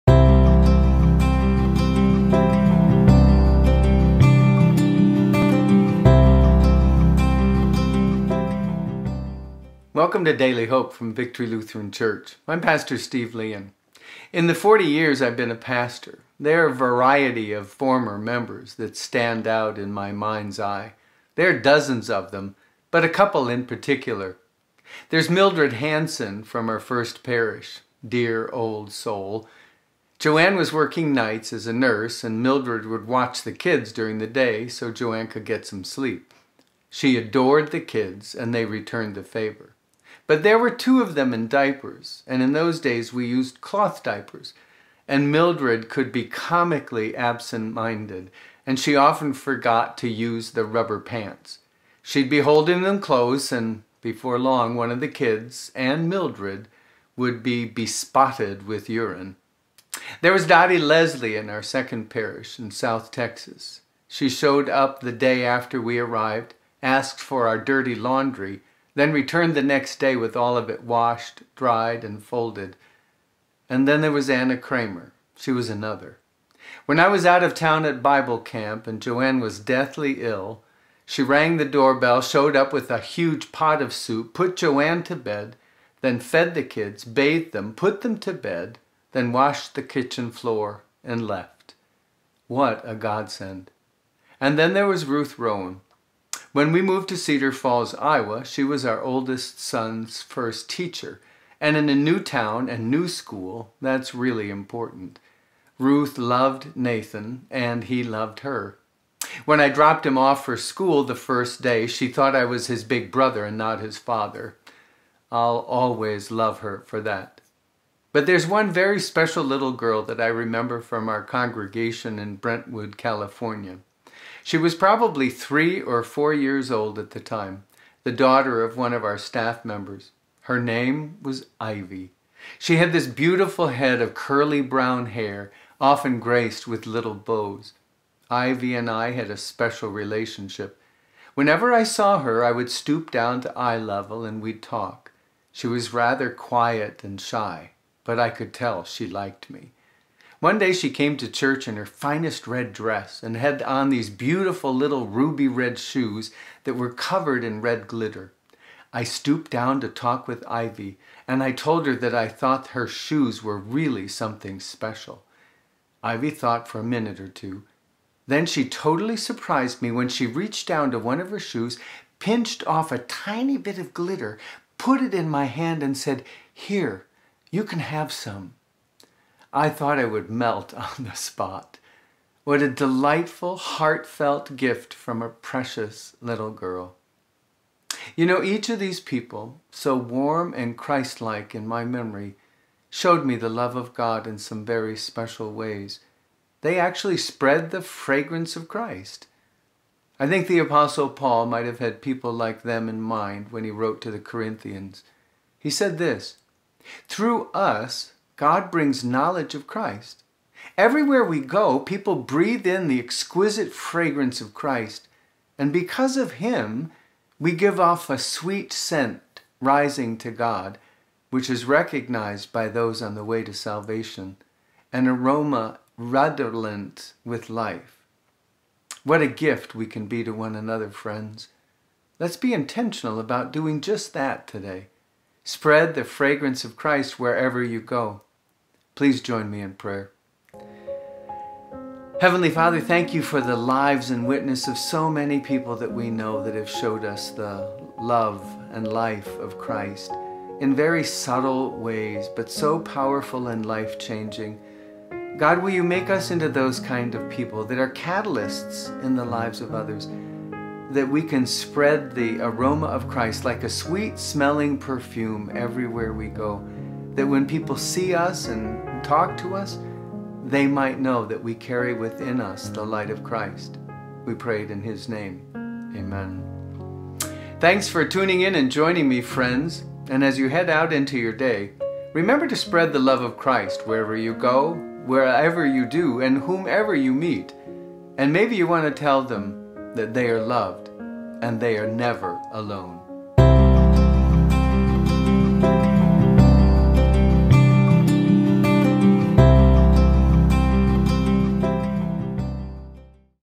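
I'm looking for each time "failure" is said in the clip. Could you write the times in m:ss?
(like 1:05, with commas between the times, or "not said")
not said.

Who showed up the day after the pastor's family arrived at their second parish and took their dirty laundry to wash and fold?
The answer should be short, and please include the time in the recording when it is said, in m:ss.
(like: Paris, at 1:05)
Dottie Leslie, at 1:00.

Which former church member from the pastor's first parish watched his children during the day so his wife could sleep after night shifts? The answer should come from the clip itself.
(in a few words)
Mildred Hanson.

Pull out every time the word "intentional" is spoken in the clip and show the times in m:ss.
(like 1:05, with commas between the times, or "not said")
3:52.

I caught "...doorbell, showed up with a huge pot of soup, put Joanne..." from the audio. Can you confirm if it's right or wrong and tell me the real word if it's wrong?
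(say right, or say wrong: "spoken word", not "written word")
right.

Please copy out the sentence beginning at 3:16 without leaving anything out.
They actually spread the fragrance of Christ.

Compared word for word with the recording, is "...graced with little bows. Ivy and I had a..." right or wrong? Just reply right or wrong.
right.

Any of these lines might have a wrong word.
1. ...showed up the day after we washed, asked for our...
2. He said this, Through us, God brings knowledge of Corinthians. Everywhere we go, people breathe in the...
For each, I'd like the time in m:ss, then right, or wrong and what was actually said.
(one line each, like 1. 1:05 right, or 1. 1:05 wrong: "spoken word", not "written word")
1. 1:04 wrong: "arrived", not "washed"
2. 3:25 wrong: "Christ", not "Corinthians".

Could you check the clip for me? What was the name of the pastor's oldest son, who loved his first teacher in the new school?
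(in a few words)
Nathan.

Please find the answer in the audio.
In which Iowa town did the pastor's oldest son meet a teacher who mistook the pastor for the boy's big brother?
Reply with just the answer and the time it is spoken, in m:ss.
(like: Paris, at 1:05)
Cedar Falls, at 1:37.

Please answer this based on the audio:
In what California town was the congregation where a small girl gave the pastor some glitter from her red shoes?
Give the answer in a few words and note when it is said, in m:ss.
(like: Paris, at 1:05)
Brentwood, at 2:02.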